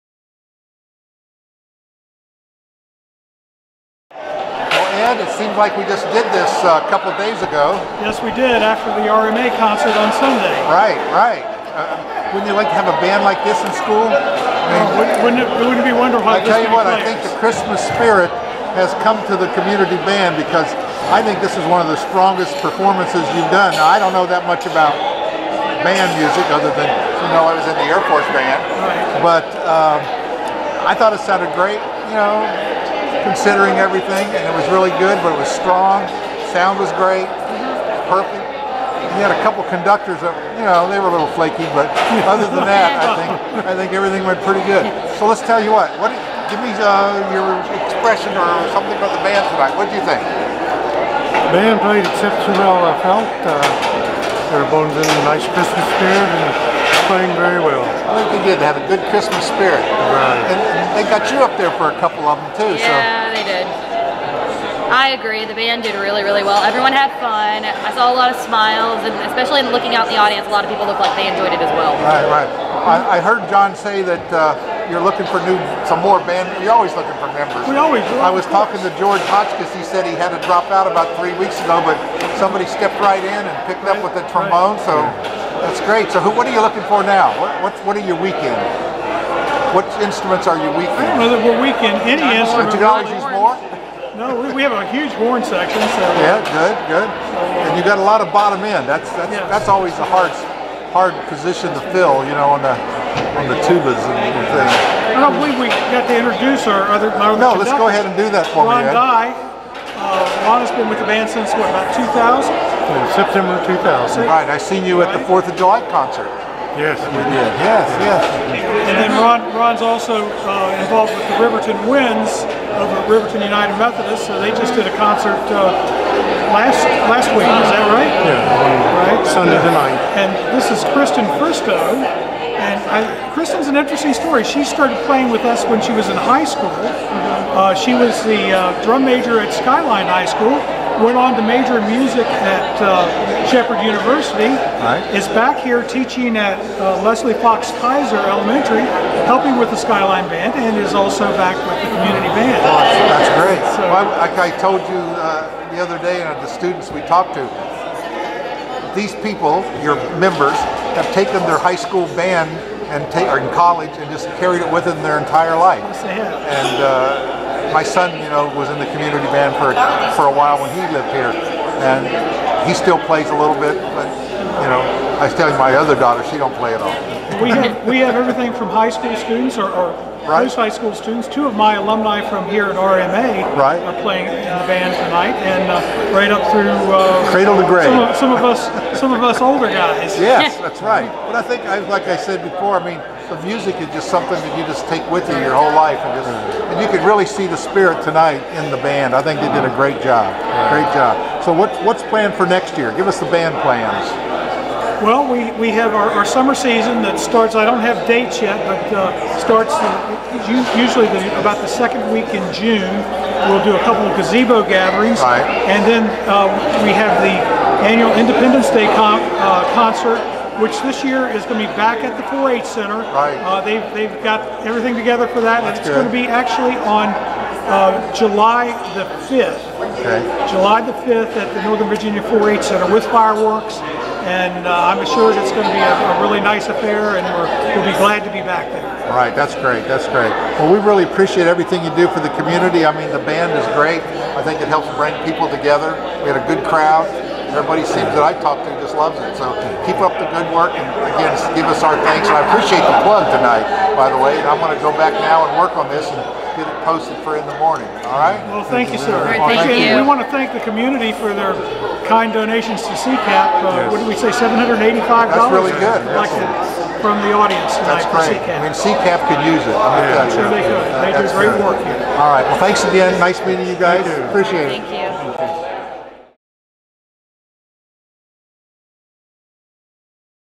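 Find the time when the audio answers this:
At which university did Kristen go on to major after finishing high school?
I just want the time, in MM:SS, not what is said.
02:23.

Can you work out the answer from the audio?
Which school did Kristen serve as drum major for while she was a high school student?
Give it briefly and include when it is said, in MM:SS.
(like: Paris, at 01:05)
Skyline High School, at 02:19.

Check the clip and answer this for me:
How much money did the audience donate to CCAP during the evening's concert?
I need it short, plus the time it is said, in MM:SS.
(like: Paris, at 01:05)
$785, at 04:24.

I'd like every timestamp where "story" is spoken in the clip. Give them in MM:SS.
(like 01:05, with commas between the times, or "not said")
02:14.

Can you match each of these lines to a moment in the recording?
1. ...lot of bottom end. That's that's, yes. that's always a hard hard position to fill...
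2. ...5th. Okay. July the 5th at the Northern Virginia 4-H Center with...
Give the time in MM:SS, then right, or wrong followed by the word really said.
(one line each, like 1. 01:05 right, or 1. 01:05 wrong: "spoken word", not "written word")
1. 01:38 right
2. 03:49 right.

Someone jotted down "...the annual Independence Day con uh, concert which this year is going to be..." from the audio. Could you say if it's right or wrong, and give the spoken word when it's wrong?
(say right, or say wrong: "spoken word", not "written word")
right.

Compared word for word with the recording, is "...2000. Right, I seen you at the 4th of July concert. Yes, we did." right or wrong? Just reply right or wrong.
right.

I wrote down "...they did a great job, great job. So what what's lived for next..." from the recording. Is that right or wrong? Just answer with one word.
wrong.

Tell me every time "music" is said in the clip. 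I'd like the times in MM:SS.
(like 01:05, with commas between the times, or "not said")
00:26, 02:21, 03:13.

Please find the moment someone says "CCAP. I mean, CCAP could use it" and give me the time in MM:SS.
04:28.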